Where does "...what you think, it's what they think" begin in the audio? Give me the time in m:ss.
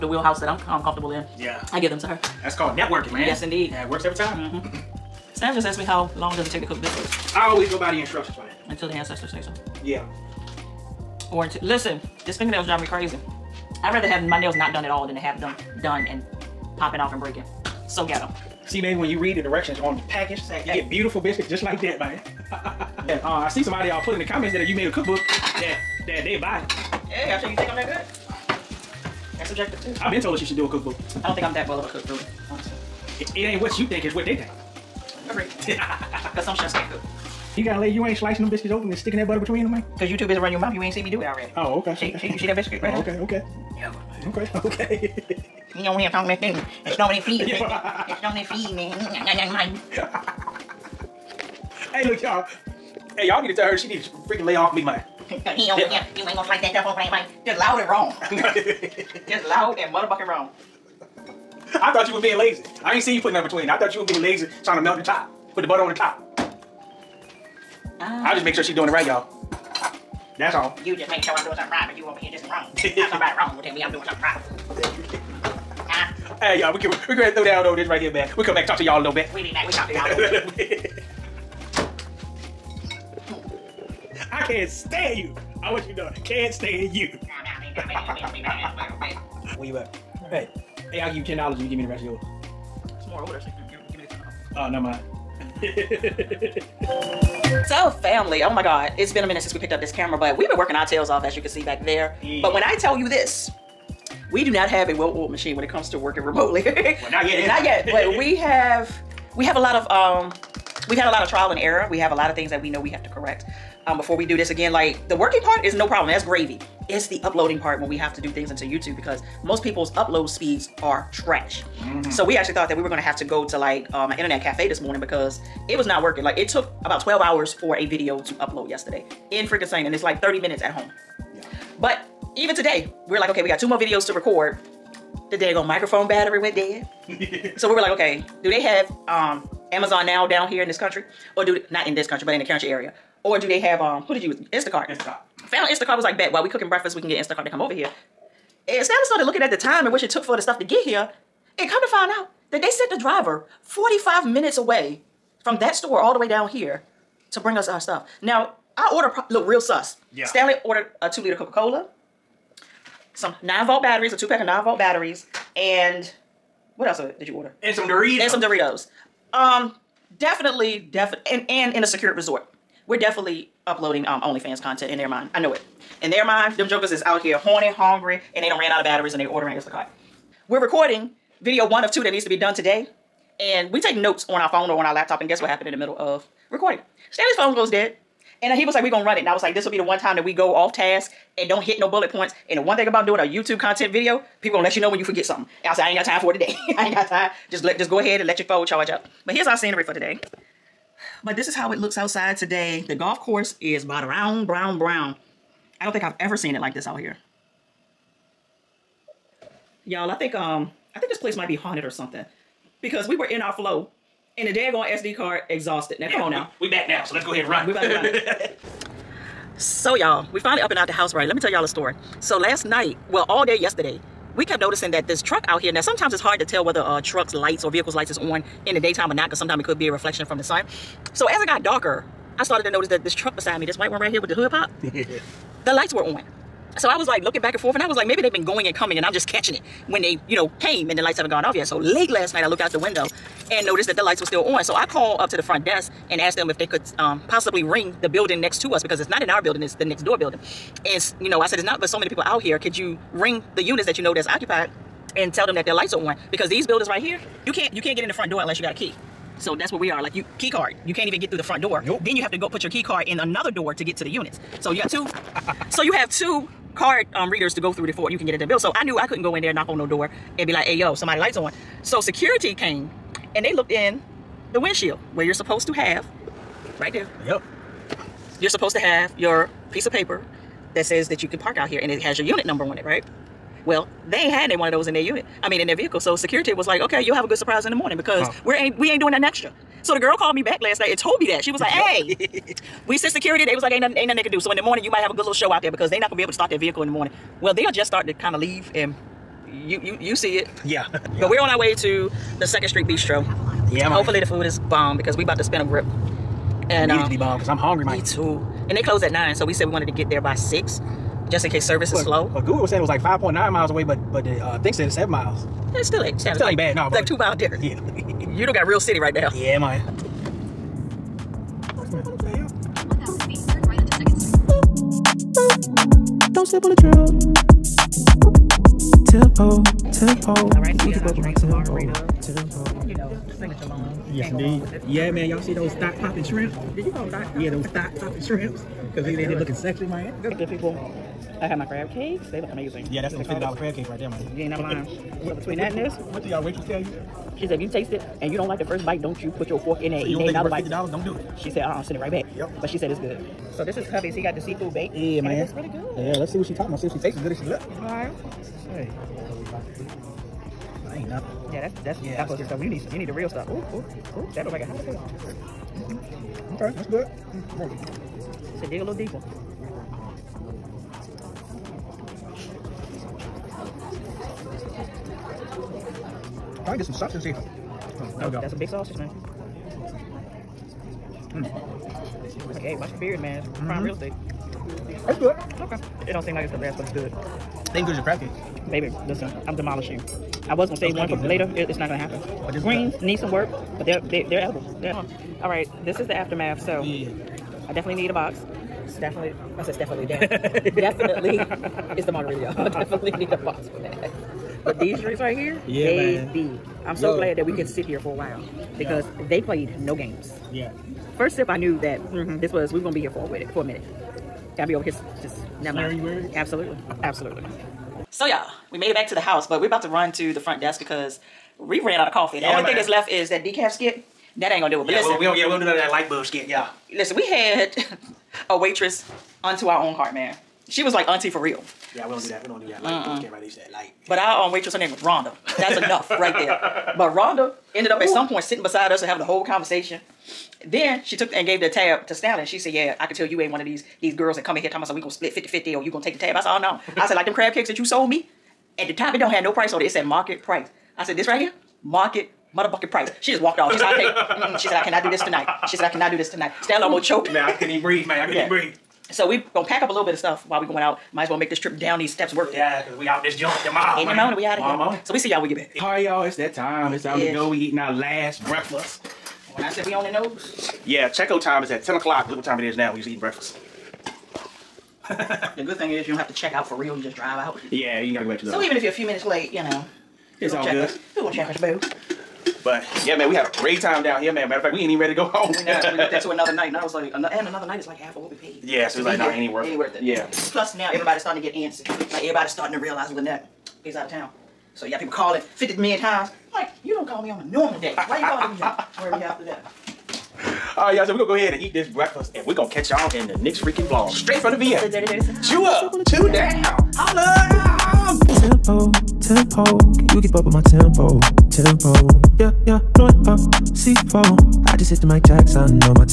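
0:33.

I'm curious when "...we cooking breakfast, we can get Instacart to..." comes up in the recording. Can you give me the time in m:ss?
2:26.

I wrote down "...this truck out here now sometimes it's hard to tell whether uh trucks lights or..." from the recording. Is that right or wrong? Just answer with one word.
right.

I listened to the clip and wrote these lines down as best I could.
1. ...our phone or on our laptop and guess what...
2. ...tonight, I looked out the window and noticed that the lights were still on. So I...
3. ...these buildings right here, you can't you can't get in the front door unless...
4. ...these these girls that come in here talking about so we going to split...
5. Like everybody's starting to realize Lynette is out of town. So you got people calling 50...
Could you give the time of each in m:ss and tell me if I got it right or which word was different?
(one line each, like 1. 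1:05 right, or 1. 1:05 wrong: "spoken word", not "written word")
1. 3:04 right
2. 4:02 wrong: "night", not "tonight"
3. 4:16 right
4. 7:23 right
5. 8:12 right.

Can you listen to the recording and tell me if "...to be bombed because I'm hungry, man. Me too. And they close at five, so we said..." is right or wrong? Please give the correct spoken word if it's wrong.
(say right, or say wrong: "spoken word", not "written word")
wrong: "nine", not "five".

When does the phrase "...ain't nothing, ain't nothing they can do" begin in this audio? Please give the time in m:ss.
4:53.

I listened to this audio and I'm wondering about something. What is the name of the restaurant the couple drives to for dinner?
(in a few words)
Second Street Bistro.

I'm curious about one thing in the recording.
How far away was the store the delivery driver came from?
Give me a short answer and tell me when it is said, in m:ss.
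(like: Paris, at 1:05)
45 minutes, at 2:33.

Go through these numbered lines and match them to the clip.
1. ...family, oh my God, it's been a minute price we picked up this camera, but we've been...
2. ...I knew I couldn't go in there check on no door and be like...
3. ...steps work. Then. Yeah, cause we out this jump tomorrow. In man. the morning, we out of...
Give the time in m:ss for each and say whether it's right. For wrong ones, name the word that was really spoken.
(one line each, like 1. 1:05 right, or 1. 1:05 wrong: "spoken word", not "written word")
1. 1:38 wrong: "since", not "price"
2. 4:28 wrong: "knock", not "check"
3. 7:42 right.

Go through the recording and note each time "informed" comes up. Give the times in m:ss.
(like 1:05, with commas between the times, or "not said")
not said.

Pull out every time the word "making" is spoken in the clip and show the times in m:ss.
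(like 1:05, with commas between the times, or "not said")
1:11.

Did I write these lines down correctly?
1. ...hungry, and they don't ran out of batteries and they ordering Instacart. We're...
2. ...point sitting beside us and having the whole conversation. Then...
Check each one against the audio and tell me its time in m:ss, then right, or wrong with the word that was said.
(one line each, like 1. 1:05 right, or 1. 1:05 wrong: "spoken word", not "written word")
1. 2:57 right
2. 7:18 right.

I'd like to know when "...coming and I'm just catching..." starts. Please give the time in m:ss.
3:58.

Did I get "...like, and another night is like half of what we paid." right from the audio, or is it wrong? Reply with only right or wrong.
right.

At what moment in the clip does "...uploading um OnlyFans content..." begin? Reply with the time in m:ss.
2:53.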